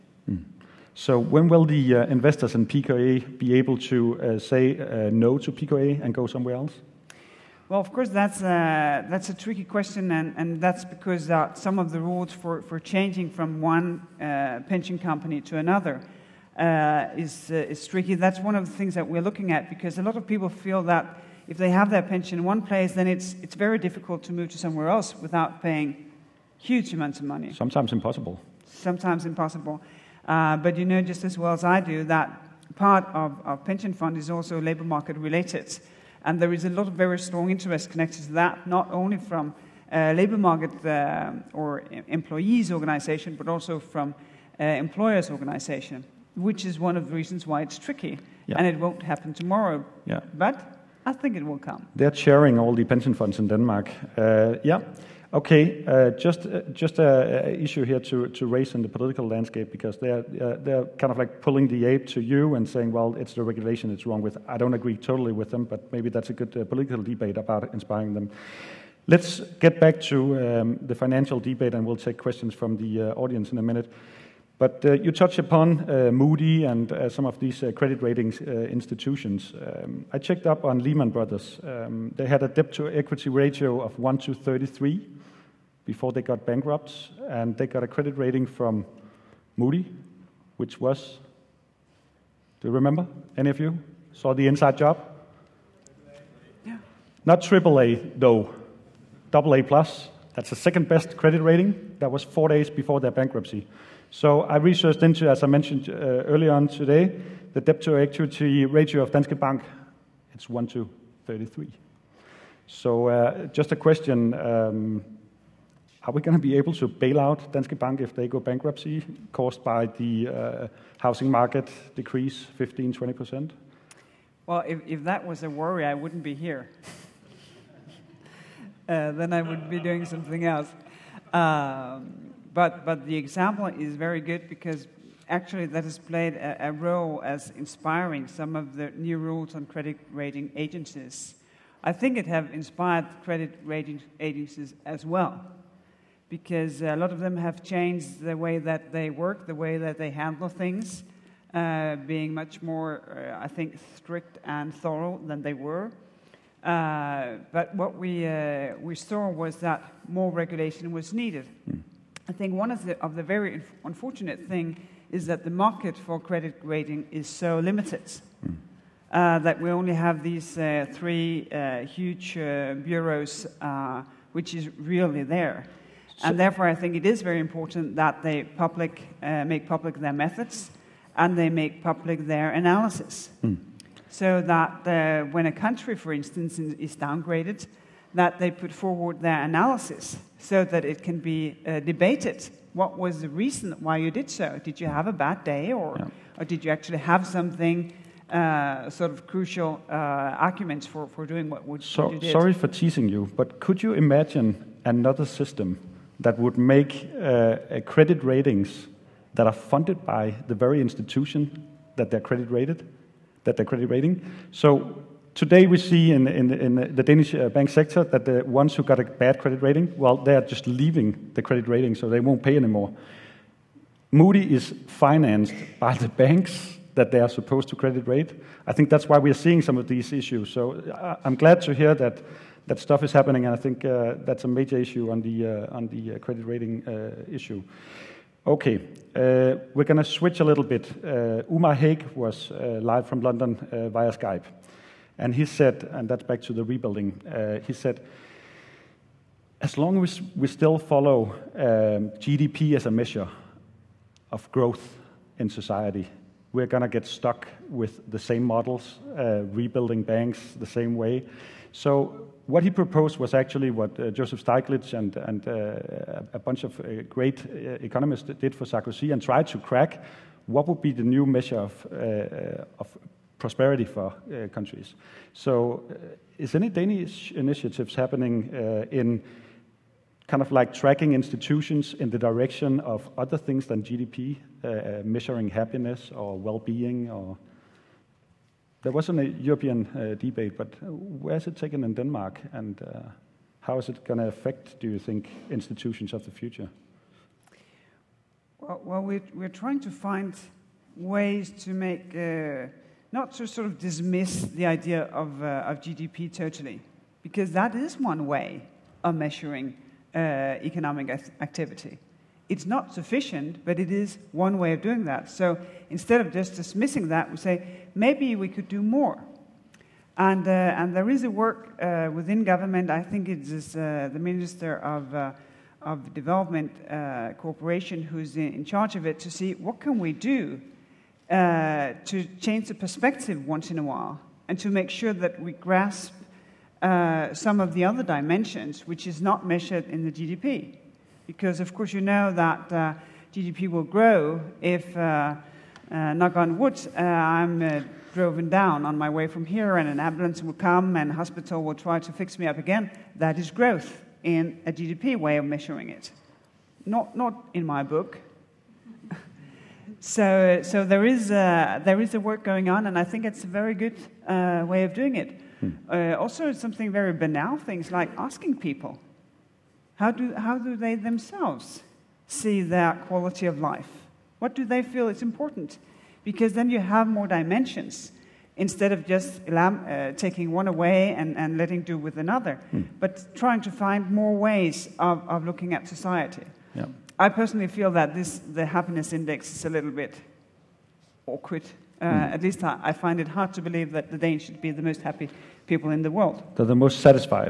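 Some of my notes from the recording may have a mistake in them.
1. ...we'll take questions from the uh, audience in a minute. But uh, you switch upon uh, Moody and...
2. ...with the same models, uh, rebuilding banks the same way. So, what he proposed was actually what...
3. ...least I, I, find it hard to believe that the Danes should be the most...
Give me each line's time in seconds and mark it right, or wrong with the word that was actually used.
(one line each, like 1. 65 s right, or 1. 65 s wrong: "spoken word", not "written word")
1. 71 s wrong: "touch", not "switch"
2. 257 s right
3. 392 s right.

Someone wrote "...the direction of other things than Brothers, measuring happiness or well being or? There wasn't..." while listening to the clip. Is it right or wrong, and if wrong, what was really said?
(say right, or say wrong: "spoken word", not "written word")
wrong: "GDP", not "Brothers".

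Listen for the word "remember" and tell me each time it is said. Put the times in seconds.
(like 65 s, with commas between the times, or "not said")
92 s.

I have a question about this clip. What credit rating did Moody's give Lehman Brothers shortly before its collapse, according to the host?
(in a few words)
AA plus.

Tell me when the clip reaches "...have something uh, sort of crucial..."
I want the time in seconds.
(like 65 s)
196 s.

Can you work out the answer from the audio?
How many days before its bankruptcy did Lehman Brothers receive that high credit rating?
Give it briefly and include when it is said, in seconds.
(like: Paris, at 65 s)
4, at 102 s.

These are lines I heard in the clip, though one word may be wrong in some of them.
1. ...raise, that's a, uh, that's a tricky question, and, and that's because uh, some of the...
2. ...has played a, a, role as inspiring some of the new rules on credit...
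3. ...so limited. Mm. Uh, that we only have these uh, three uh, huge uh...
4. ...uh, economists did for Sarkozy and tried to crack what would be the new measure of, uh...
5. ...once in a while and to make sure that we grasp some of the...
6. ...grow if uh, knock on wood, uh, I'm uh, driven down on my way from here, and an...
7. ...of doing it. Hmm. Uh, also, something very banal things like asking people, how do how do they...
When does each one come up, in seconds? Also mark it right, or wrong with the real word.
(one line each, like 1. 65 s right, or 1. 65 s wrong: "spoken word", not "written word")
1. 7 s wrong: "course", not "raise"
2. 135 s right
3. 167 s right
4. 267 s right
5. 333 s right
6. 343 s right
7. 364 s right.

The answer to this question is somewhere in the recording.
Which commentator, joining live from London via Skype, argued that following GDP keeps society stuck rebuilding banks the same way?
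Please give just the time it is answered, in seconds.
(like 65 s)
241 s.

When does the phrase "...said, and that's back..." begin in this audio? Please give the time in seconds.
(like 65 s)
245 s.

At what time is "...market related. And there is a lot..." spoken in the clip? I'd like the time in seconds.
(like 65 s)
34 s.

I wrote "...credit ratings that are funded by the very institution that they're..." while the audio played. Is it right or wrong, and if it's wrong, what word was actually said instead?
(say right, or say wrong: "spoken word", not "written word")
right.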